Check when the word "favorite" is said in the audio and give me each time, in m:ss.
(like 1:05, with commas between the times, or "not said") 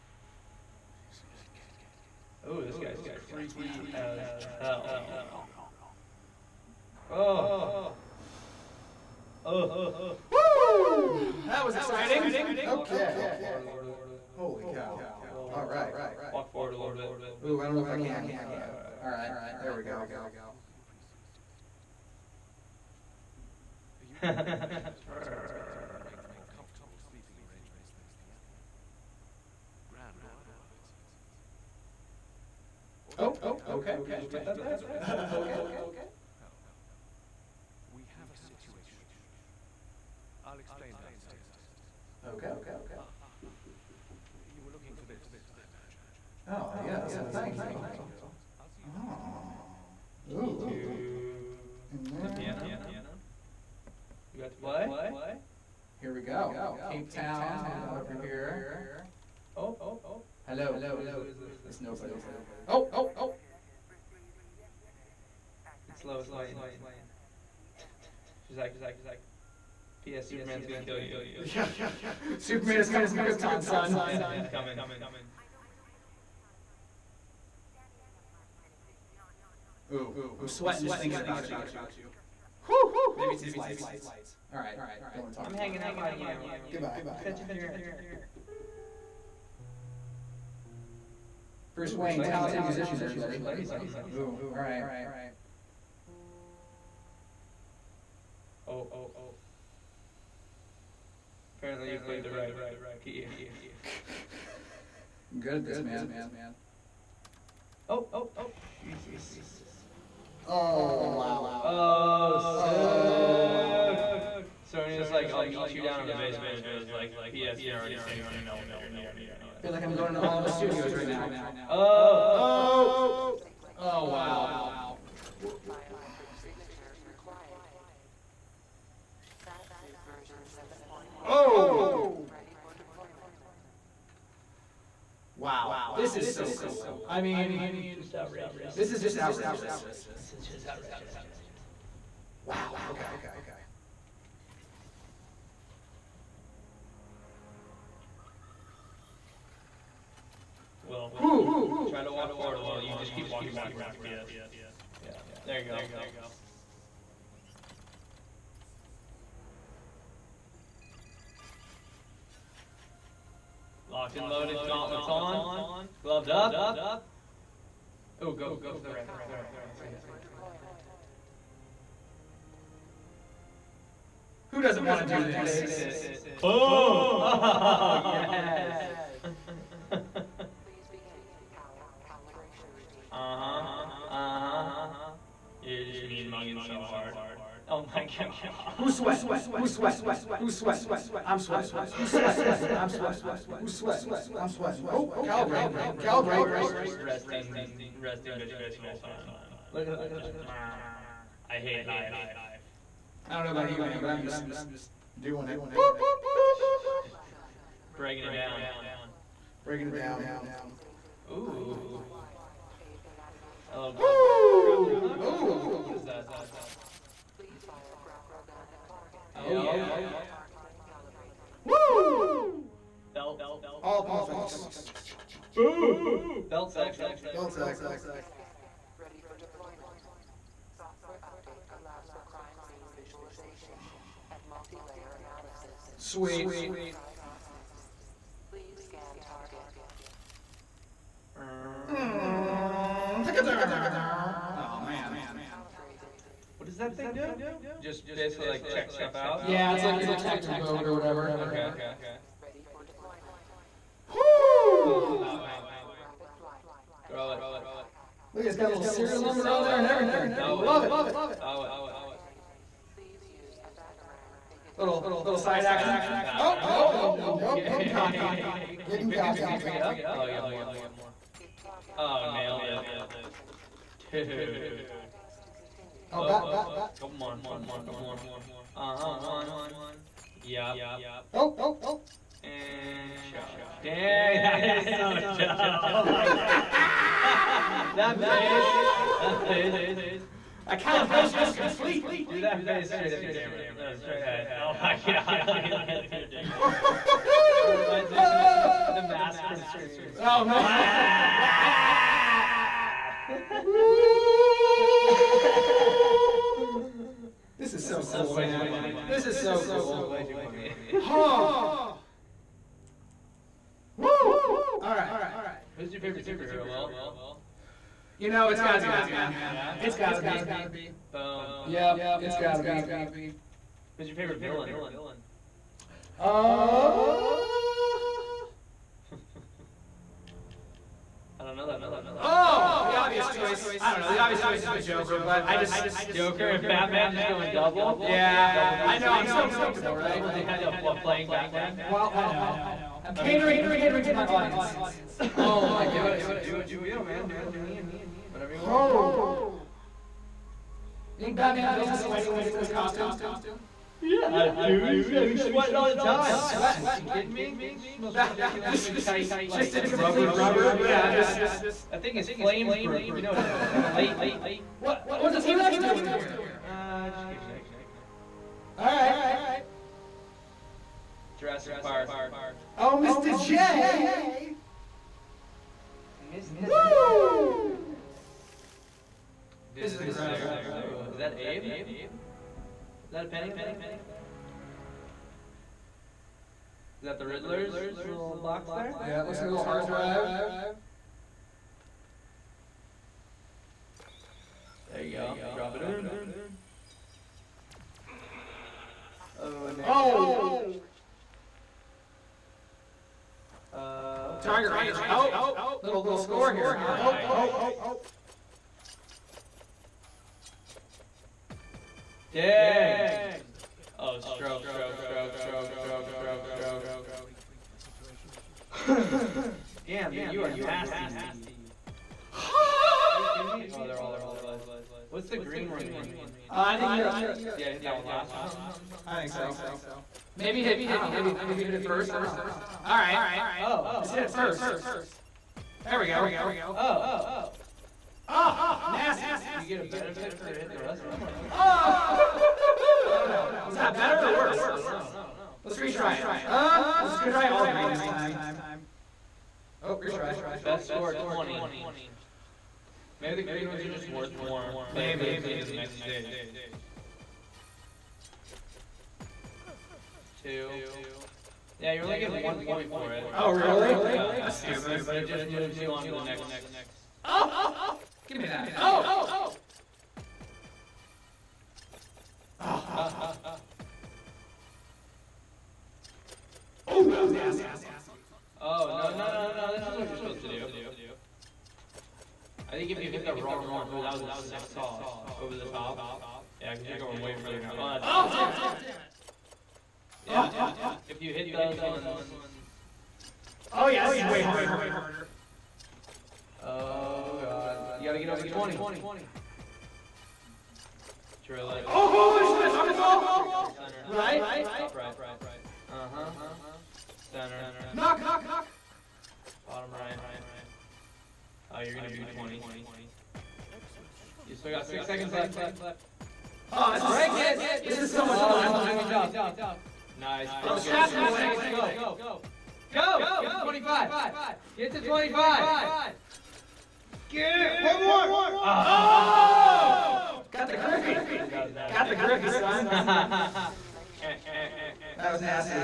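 5:16, 5:24.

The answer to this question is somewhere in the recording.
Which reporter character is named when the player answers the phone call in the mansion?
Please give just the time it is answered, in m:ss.
1:06.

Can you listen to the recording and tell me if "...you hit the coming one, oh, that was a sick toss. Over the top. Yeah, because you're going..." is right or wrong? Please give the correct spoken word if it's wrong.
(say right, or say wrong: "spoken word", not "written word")
wrong: "wrong", not "coming".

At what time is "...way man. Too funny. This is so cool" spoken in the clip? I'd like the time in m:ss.
5:08.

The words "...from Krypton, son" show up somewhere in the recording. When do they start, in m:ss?
1:13.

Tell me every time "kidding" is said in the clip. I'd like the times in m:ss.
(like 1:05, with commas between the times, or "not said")
5:57, 7:03.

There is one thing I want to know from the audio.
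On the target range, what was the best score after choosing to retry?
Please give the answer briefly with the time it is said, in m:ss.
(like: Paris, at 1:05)
20, at 7:30.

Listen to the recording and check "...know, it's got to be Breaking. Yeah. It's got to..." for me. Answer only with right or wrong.
wrong.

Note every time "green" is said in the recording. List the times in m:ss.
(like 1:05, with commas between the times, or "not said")
7:05, 7:27, 7:33.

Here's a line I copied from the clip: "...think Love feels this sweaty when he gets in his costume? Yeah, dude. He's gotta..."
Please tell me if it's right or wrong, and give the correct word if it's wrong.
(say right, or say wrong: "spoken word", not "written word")
wrong: "Batman", not "Love".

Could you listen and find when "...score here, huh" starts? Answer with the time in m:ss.
6:46.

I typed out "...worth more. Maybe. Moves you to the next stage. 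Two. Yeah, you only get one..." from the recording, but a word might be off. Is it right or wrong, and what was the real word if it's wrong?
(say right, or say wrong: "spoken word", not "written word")
right.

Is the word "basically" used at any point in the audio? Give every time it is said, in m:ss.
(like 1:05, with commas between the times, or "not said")
4:08.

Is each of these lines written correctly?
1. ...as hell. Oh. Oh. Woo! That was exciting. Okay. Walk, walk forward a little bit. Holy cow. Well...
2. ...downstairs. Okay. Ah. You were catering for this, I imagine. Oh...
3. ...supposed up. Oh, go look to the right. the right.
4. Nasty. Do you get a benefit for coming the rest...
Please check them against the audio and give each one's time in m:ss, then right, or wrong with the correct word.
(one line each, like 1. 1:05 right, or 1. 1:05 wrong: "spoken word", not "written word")
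1. 0:03 right
2. 0:41 wrong: "looking", not "catering"
3. 2:46 wrong: "gloved", not "supposed"
4. 7:18 wrong: "hitting", not "coming".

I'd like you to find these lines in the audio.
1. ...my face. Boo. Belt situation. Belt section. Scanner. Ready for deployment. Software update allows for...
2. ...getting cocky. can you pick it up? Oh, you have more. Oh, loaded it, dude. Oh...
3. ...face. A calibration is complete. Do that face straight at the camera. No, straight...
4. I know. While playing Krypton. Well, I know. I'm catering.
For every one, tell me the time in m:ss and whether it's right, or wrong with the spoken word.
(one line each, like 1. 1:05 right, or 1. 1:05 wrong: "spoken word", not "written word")
1. 3:44 wrong: "section", not "situation"
2. 4:28 wrong: "nailed", not "loaded"
3. 4:49 right
4. 5:40 wrong: "Batman", not "Krypton".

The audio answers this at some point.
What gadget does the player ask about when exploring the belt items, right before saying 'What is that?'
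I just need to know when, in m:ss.
3:34.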